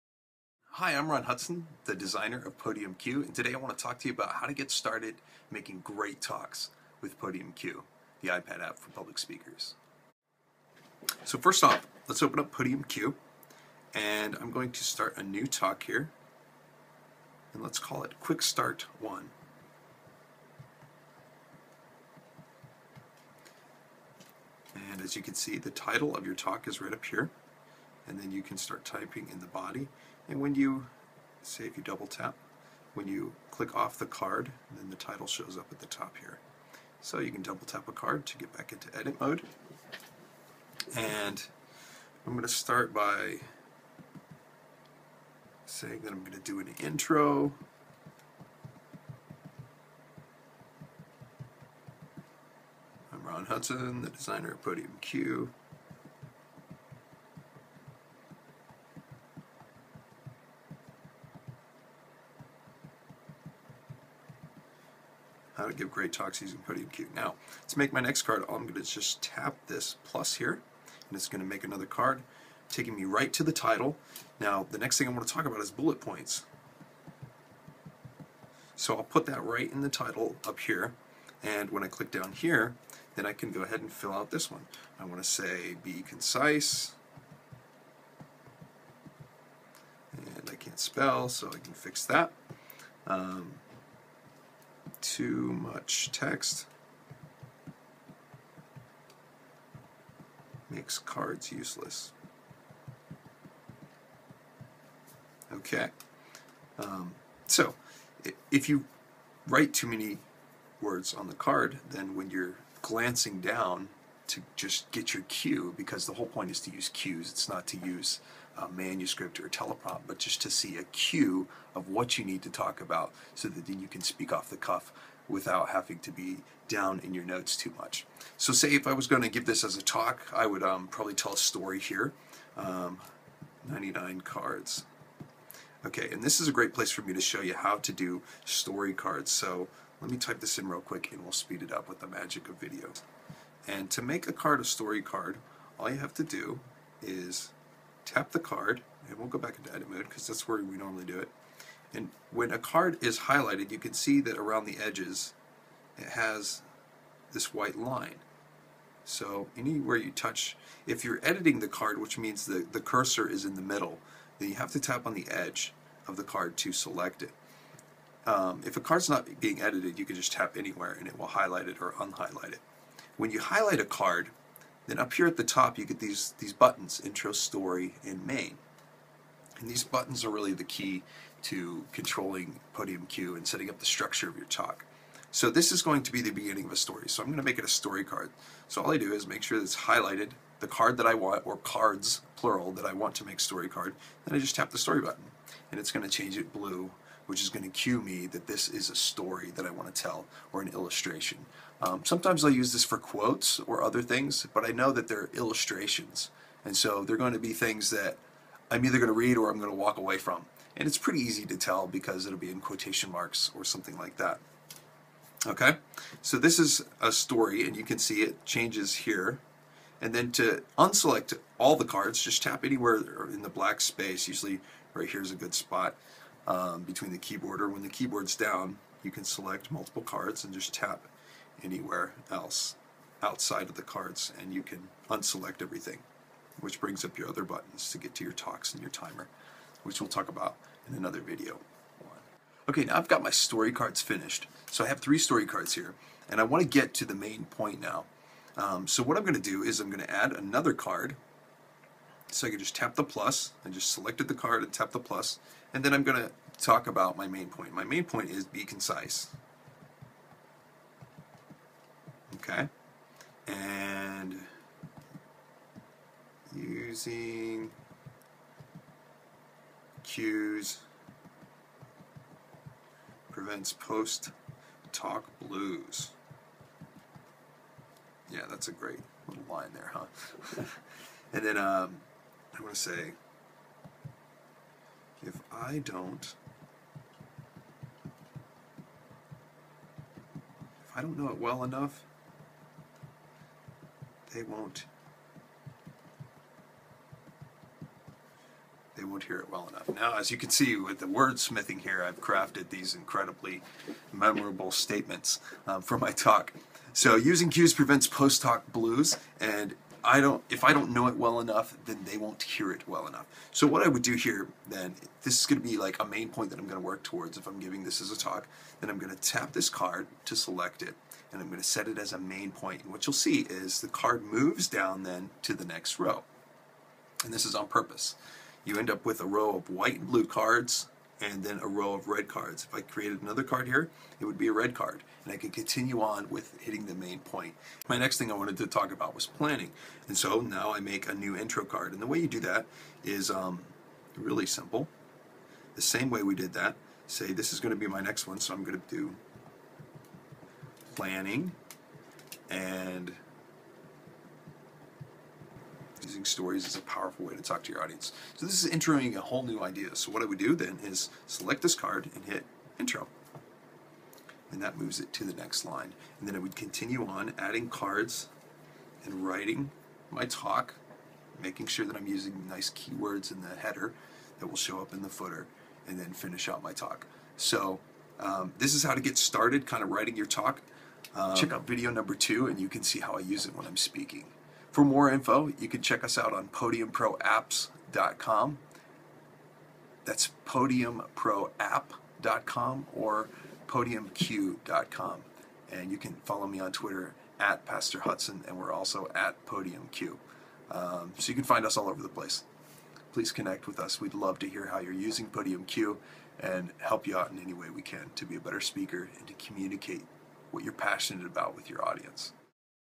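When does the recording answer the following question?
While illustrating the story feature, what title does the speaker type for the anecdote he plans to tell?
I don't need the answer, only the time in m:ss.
2:13.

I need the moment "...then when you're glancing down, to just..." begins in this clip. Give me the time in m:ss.
1:51.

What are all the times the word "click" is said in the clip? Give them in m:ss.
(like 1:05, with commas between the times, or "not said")
0:33, 1:21.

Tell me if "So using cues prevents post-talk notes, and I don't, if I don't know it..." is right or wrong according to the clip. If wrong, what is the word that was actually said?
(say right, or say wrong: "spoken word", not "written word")
wrong: "blues", not "notes".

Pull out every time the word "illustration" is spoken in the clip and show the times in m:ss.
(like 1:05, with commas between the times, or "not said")
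3:20, 3:25.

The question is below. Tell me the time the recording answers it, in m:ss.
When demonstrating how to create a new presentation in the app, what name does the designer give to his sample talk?
0:18.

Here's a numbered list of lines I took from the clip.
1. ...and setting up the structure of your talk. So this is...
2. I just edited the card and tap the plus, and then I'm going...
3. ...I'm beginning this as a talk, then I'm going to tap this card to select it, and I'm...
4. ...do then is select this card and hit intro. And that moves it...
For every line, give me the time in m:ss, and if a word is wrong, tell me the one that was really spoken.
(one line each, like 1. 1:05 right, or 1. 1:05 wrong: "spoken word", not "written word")
1. 3:03 right
2. 4:13 wrong: "selected", not "edited"
3. 5:17 wrong: "giving", not "beginning"
4. 6:00 right.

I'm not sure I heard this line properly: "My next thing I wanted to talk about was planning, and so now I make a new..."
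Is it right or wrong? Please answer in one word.
right.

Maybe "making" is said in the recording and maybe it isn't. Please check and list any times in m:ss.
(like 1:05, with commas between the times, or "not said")
0:05, 6:11.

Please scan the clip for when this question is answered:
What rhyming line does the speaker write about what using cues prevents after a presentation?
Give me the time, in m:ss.
4:33.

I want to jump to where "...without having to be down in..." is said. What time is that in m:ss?
2:05.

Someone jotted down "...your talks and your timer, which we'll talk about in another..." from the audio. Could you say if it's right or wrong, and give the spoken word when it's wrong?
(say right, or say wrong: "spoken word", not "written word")
right.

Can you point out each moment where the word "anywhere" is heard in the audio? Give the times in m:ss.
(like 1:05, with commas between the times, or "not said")
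2:39, 2:50, 3:42, 3:51.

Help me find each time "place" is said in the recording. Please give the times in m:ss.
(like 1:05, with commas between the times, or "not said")
2:16, 6:42.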